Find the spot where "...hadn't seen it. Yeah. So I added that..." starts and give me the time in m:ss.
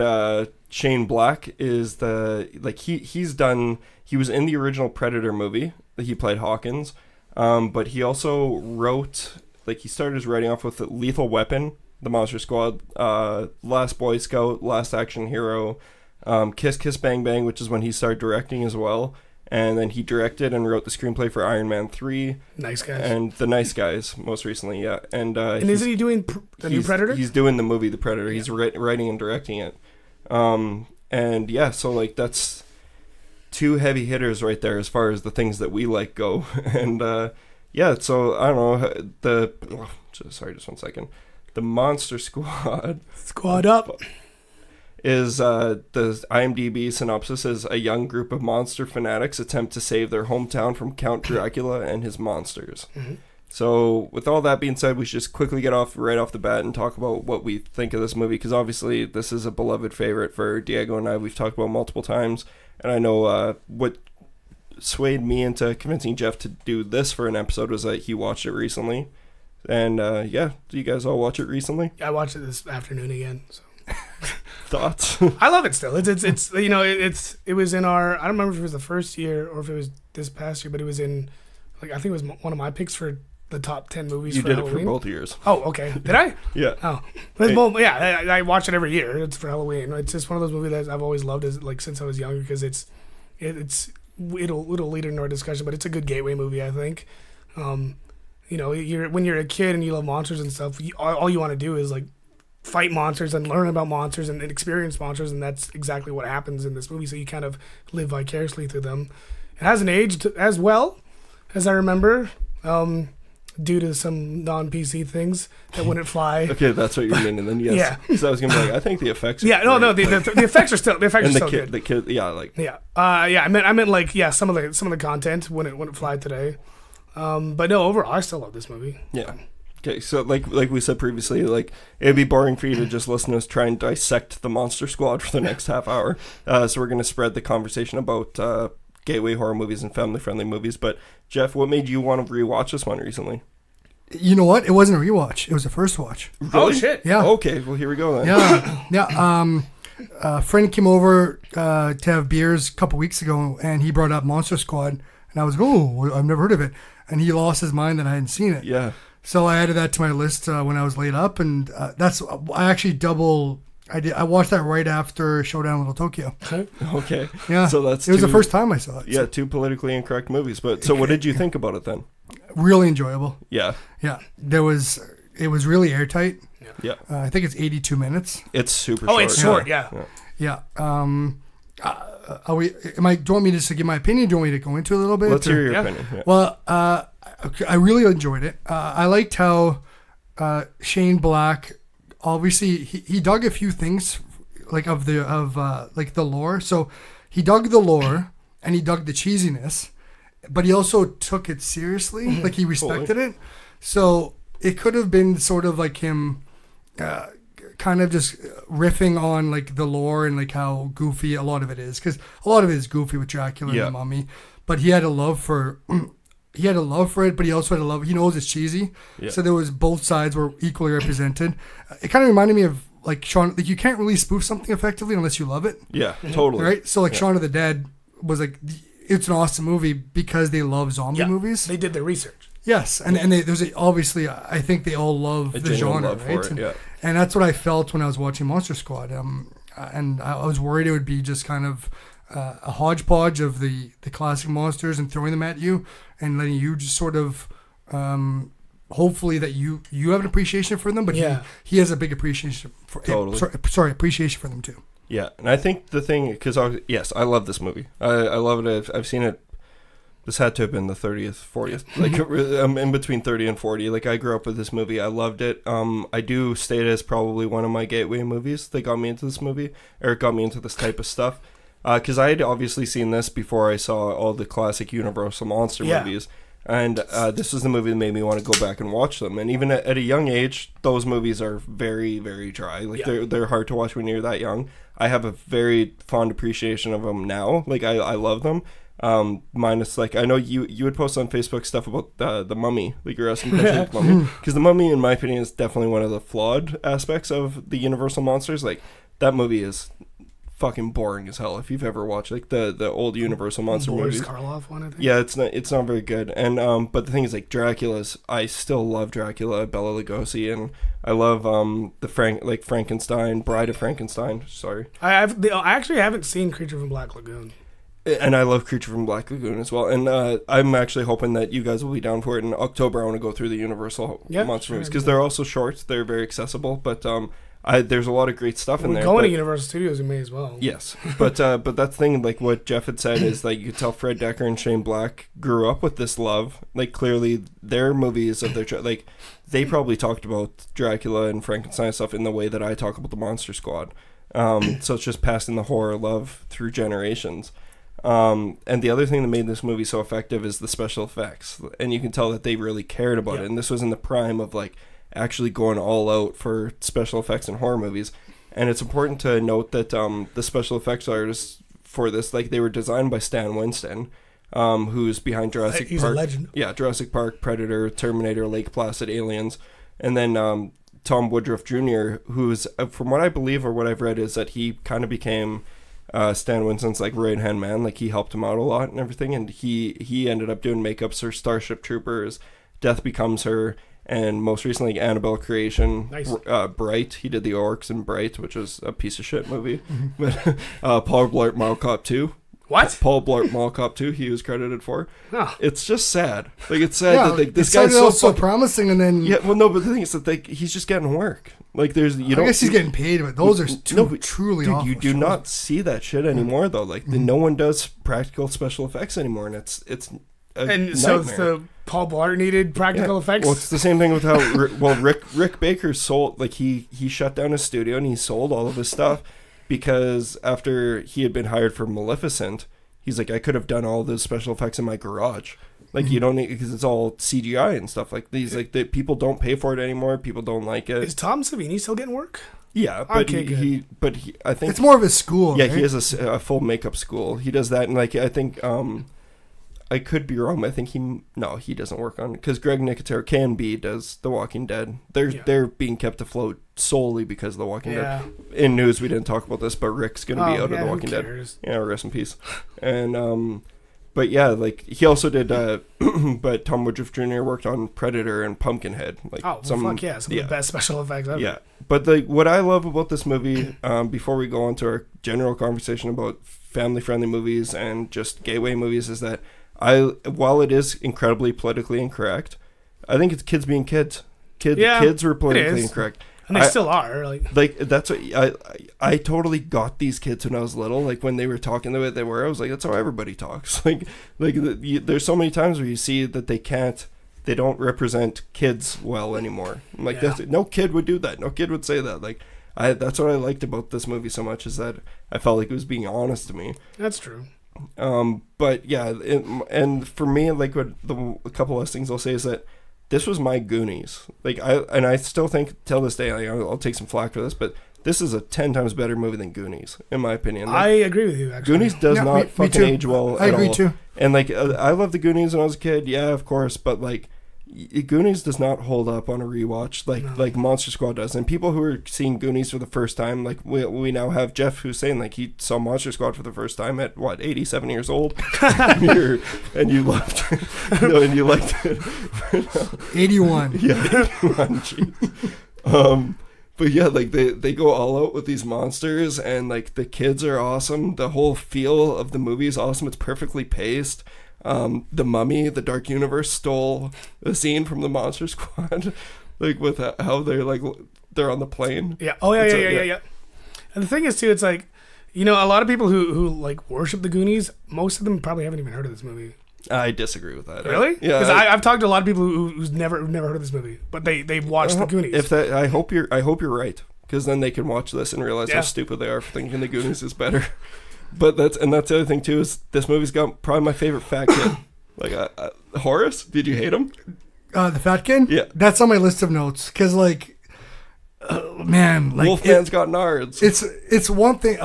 2:38.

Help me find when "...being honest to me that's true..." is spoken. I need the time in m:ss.
8:15.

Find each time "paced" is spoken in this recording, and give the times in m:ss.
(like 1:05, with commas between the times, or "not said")
9:03.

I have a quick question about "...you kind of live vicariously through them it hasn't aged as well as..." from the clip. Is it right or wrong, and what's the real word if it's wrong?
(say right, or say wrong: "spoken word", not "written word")
right.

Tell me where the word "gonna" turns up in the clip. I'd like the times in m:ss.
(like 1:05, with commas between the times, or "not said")
1:58, 2:16, 7:30.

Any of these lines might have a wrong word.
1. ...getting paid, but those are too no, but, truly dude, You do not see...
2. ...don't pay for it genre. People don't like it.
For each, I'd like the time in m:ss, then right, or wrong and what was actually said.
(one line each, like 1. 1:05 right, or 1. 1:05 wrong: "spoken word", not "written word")
1. 6:42 right
2. 7:09 wrong: "anymore", not "genre".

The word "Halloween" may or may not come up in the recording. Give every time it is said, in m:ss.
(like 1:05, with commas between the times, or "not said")
1:24, 1:29.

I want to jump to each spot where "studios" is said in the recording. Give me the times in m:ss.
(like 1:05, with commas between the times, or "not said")
5:29, 6:57.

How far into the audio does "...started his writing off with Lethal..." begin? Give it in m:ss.
0:09.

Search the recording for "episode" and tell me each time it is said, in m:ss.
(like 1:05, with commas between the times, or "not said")
1:07.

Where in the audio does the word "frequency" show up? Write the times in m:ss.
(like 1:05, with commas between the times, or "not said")
not said.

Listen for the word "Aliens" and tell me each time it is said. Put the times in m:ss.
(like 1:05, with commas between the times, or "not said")
6:09.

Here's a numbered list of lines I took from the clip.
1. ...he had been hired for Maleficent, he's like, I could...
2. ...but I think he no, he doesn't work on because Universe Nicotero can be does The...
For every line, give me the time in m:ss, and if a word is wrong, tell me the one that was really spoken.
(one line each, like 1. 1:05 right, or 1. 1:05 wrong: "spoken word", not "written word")
1. 7:01 right
2. 7:20 wrong: "Greg", not "Universe".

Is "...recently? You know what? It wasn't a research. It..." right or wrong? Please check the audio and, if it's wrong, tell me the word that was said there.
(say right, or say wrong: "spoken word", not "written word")
wrong: "rewatch", not "research".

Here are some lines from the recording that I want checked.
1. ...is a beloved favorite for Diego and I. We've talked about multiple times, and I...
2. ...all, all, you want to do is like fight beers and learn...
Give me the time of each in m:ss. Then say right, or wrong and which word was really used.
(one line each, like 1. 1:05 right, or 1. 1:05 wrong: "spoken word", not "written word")
1. 0:59 right
2. 1:40 wrong: "monsters", not "beers".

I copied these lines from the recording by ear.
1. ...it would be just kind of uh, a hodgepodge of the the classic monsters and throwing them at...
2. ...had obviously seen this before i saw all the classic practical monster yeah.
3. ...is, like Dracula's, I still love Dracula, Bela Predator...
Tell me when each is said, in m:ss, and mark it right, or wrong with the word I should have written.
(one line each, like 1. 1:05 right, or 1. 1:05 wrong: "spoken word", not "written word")
1. 4:00 right
2. 4:32 wrong: "universal", not "practical"
3. 5:07 wrong: "Lugosi", not "Predator".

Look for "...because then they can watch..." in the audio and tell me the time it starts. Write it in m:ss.
9:27.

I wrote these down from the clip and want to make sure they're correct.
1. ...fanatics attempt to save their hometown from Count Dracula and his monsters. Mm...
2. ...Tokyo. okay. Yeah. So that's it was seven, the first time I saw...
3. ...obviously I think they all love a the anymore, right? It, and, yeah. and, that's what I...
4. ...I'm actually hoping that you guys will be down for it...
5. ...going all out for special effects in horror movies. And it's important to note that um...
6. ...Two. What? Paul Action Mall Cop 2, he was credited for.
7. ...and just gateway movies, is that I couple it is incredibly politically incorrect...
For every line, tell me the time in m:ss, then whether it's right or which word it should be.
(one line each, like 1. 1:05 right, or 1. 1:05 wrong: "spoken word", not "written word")
1. 0:48 right
2. 2:45 wrong: "two", not "seven"
3. 3:53 wrong: "genre", not "anymore"
4. 5:20 right
5. 5:55 right
6. 6:32 wrong: "Blart", not "Action"
7. 7:47 wrong: "while", not "couple".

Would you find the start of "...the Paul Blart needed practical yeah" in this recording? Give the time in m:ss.
6:51.